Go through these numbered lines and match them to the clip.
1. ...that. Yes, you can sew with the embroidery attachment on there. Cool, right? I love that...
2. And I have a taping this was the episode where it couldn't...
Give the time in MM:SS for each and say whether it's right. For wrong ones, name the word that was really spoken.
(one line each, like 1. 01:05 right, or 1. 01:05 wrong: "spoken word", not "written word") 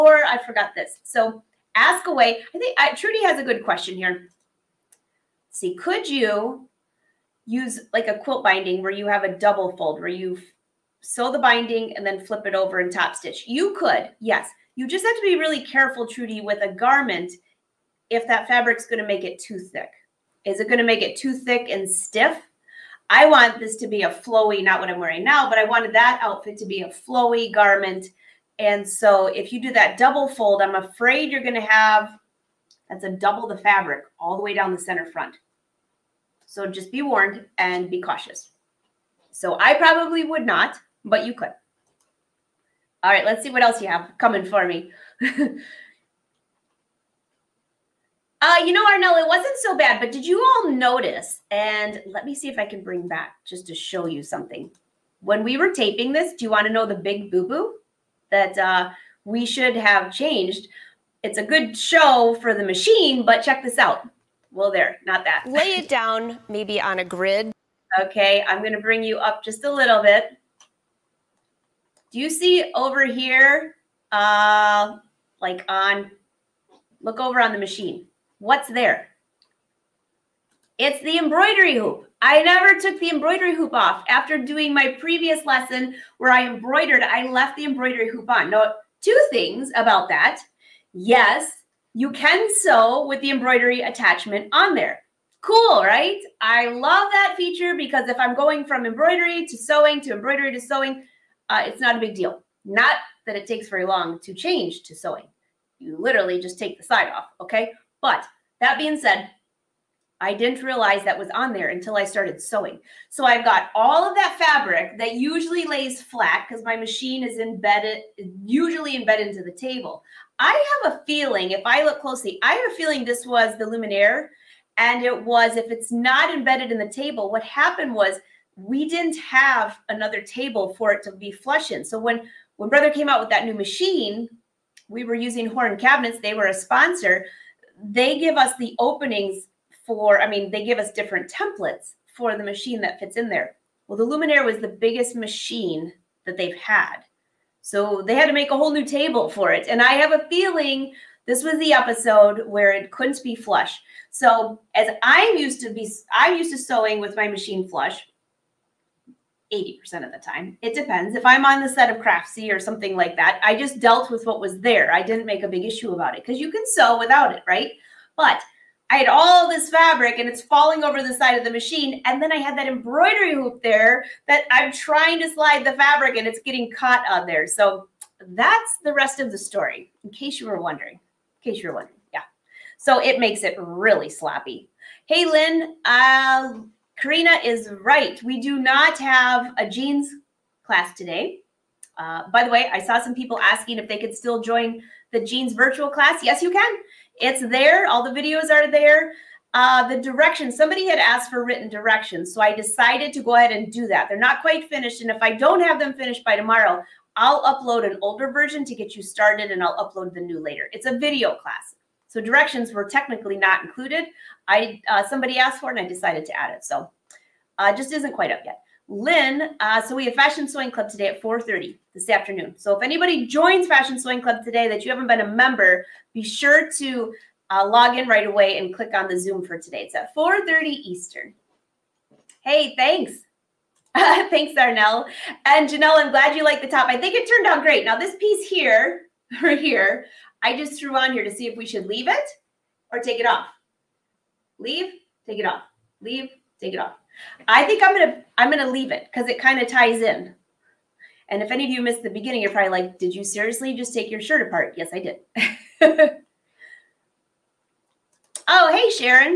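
1. 01:30 right
2. 02:29 wrong: "feeling", not "taping".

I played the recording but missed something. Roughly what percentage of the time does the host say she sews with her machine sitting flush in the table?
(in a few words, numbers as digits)
80%.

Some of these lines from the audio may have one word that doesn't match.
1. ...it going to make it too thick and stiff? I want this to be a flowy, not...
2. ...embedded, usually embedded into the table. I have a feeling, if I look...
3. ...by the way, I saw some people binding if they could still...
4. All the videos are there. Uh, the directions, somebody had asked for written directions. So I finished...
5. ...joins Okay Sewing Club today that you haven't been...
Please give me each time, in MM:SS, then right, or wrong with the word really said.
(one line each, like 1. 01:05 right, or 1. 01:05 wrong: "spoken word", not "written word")
1. 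00:20 right
2. 01:57 right
3. 03:12 wrong: "asking", not "binding"
4. 03:17 wrong: "decided", not "finished"
5. 03:43 wrong: "Fashion", not "Okay".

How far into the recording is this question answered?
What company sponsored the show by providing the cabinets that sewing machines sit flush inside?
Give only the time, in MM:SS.
02:15.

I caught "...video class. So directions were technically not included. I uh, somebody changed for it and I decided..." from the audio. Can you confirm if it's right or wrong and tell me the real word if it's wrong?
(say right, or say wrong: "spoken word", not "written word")
wrong: "asked", not "changed".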